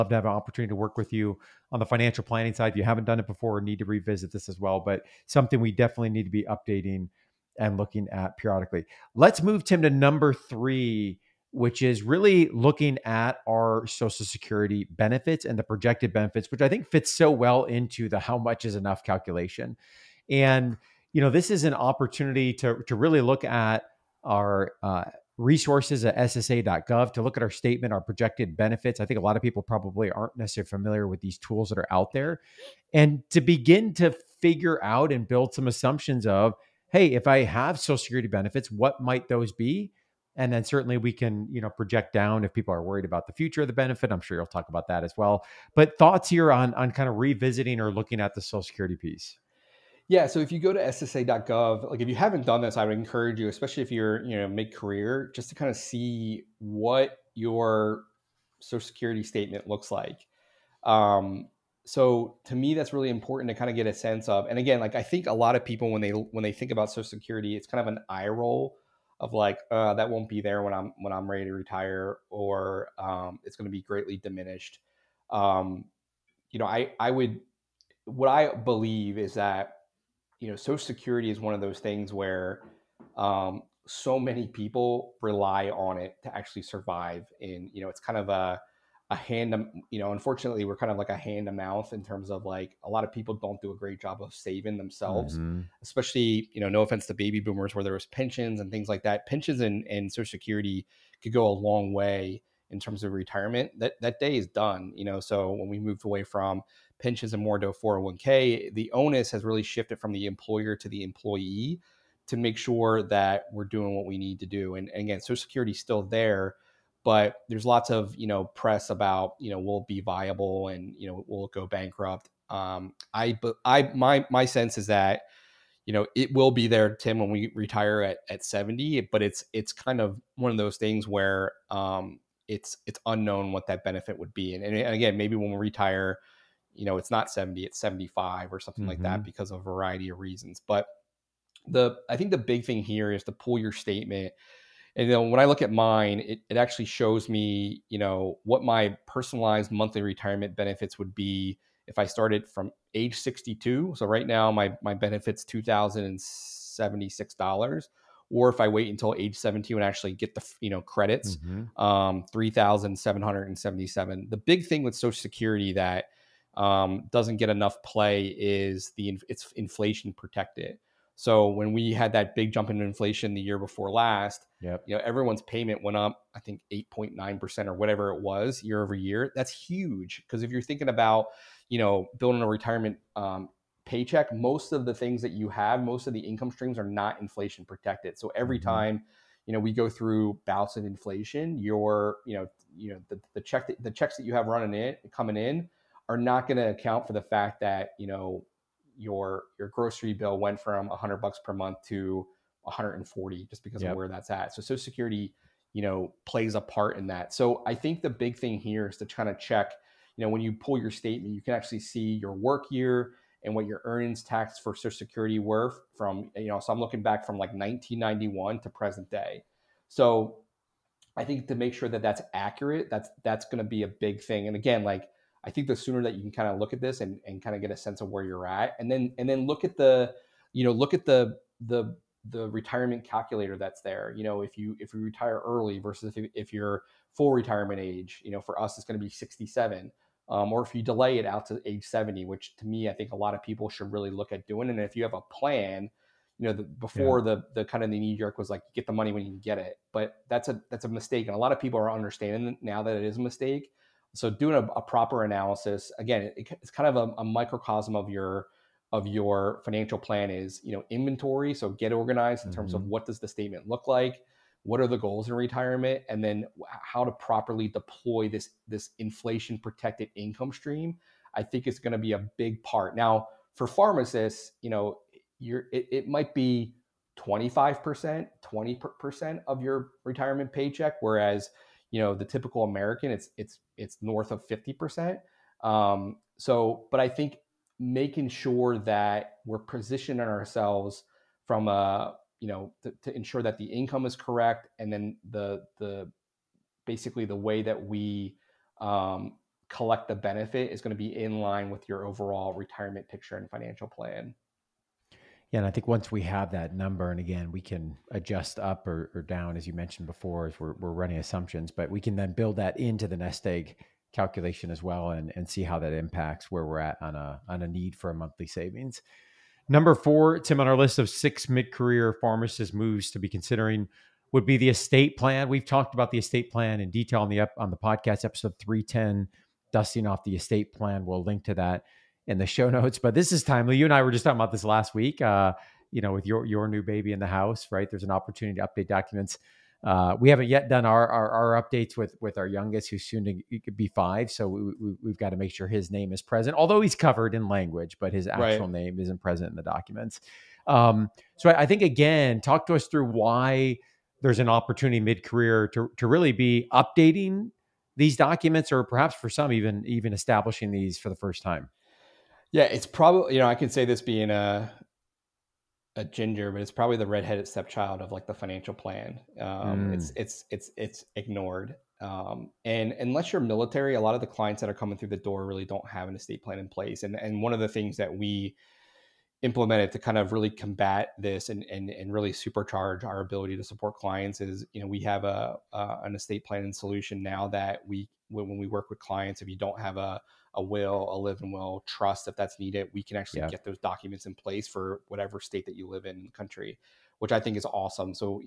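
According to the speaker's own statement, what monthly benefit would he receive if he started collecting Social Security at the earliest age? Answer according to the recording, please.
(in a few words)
$2,076.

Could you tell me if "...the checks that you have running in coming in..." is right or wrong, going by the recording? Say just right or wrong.
right.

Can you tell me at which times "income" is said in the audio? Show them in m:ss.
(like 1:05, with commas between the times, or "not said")
3:06, 4:30, 4:53.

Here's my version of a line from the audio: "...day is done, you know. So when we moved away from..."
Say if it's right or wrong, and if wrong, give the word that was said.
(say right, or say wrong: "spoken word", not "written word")
right.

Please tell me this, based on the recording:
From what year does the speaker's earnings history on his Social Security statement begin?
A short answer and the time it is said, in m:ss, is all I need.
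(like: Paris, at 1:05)
1991, at 3:37.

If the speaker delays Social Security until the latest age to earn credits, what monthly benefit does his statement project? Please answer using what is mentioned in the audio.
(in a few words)
3,777.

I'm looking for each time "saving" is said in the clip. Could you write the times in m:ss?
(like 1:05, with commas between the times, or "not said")
1:34, 5:18.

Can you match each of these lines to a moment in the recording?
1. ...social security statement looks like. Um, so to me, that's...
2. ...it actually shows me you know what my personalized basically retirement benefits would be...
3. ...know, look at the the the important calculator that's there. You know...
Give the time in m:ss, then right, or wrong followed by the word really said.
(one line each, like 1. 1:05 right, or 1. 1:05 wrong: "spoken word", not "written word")
1. 0:58 right
2. 2:26 wrong: "monthly", not "basically"
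3. 3:50 wrong: "retirement", not "important".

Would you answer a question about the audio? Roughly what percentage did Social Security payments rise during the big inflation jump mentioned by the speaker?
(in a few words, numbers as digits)
8.9%.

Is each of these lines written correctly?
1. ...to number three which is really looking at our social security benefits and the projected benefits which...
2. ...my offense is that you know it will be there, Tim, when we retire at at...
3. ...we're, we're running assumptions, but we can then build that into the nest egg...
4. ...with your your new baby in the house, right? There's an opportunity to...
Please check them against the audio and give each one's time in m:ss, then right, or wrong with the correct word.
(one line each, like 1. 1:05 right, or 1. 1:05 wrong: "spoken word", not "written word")
1. 0:09 right
2. 2:04 wrong: "sense", not "offense"
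3. 5:10 right
4. 5:36 right.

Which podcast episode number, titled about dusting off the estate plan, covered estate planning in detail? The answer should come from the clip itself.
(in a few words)
310.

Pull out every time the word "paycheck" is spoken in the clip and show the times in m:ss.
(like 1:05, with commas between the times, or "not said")
3:03, 4:40.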